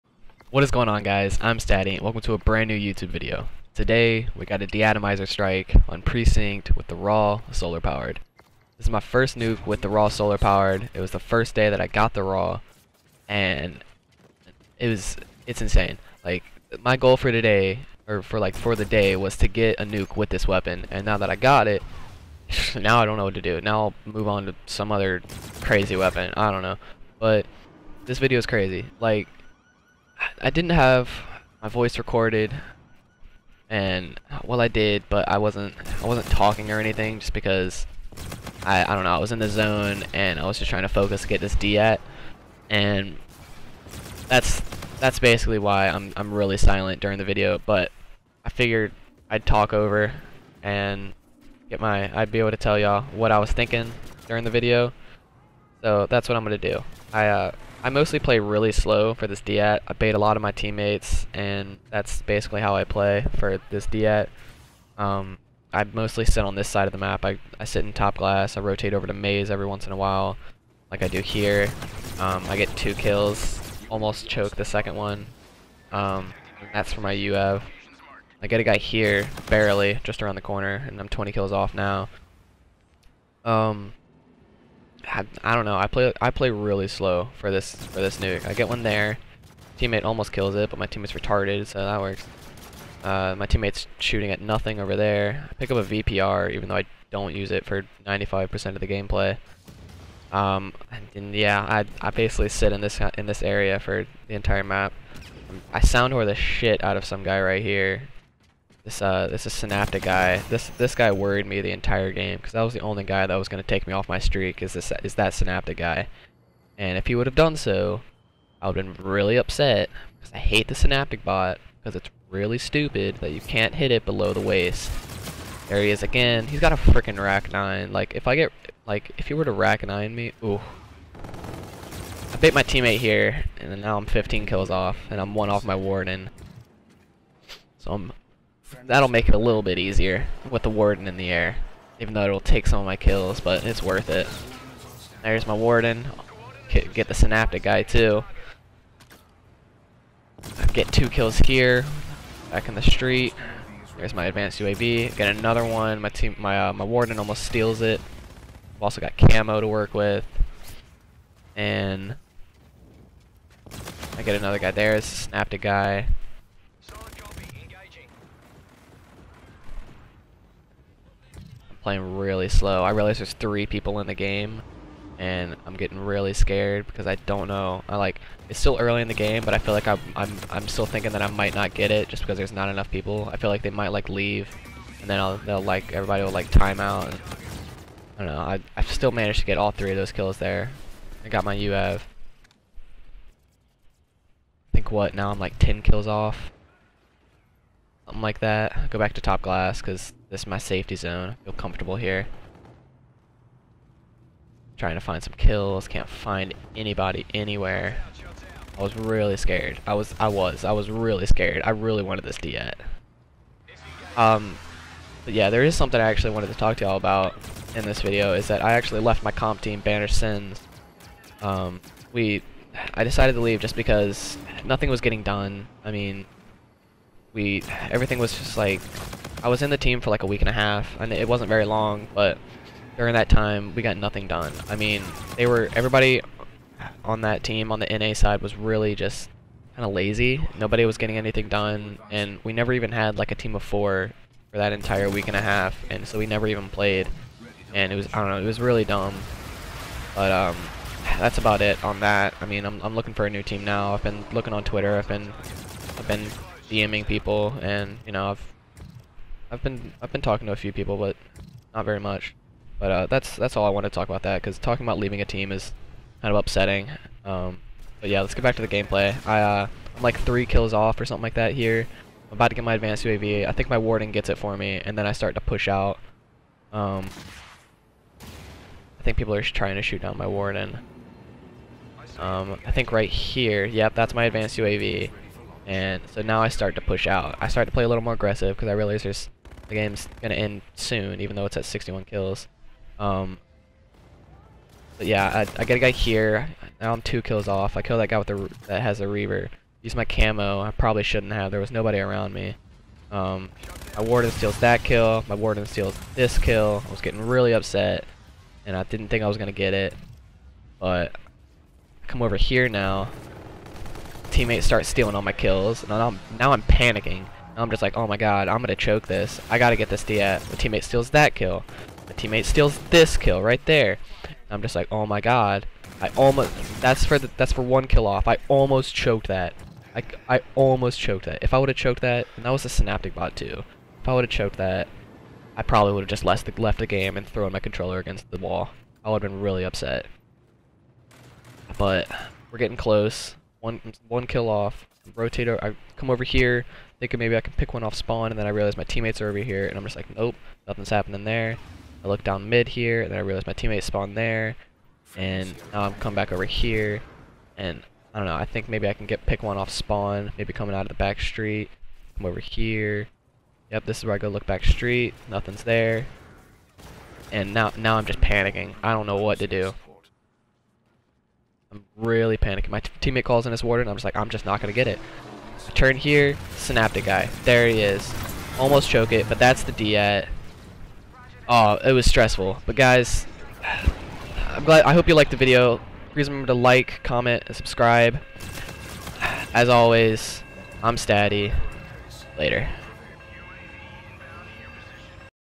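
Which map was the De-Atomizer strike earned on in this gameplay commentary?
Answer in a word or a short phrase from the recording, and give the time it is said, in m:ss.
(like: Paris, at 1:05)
Precinct, at 0:06.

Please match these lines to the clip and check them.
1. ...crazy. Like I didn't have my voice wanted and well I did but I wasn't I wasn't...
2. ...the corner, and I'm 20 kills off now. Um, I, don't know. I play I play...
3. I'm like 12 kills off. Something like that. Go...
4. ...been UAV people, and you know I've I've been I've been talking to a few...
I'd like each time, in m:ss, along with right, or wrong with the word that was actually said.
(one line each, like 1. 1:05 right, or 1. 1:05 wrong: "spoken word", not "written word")
1. 0:28 wrong: "recorded", not "wanted"
2. 1:20 right
3. 3:15 wrong: "10", not "12"
4. 4:16 wrong: "DMing", not "UAV".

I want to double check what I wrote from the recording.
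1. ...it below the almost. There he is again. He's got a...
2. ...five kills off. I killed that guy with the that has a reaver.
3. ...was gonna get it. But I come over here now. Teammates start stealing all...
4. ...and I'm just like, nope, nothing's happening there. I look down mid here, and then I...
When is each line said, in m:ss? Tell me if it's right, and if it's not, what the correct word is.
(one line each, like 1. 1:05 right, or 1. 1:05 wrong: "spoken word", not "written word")
1. 2:03 wrong: "waist", not "almost"
2. 4:57 wrong: "two", not "five"
3. 5:09 right
4. 5:49 right.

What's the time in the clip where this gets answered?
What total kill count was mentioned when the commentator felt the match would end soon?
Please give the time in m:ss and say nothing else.
4:51.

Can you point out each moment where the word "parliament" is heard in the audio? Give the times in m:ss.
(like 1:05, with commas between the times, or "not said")
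not said.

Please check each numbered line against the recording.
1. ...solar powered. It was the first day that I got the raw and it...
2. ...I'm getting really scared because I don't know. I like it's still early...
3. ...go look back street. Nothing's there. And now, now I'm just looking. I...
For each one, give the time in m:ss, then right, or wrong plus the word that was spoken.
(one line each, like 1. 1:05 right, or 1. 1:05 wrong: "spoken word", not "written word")
1. 0:10 right
2. 2:55 right
3. 6:04 wrong: "panicking", not "looking".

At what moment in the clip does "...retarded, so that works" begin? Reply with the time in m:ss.
1:31.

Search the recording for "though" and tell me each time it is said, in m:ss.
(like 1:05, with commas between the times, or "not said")
1:36, 2:22, 4:51.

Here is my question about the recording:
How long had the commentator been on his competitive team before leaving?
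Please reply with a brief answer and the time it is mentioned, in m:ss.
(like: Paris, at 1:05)
a week and a half, at 3:50.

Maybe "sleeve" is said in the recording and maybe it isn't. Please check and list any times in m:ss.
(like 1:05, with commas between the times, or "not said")
not said.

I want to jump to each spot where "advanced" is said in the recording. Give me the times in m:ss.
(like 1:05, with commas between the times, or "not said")
2:34, 4:32, 4:44.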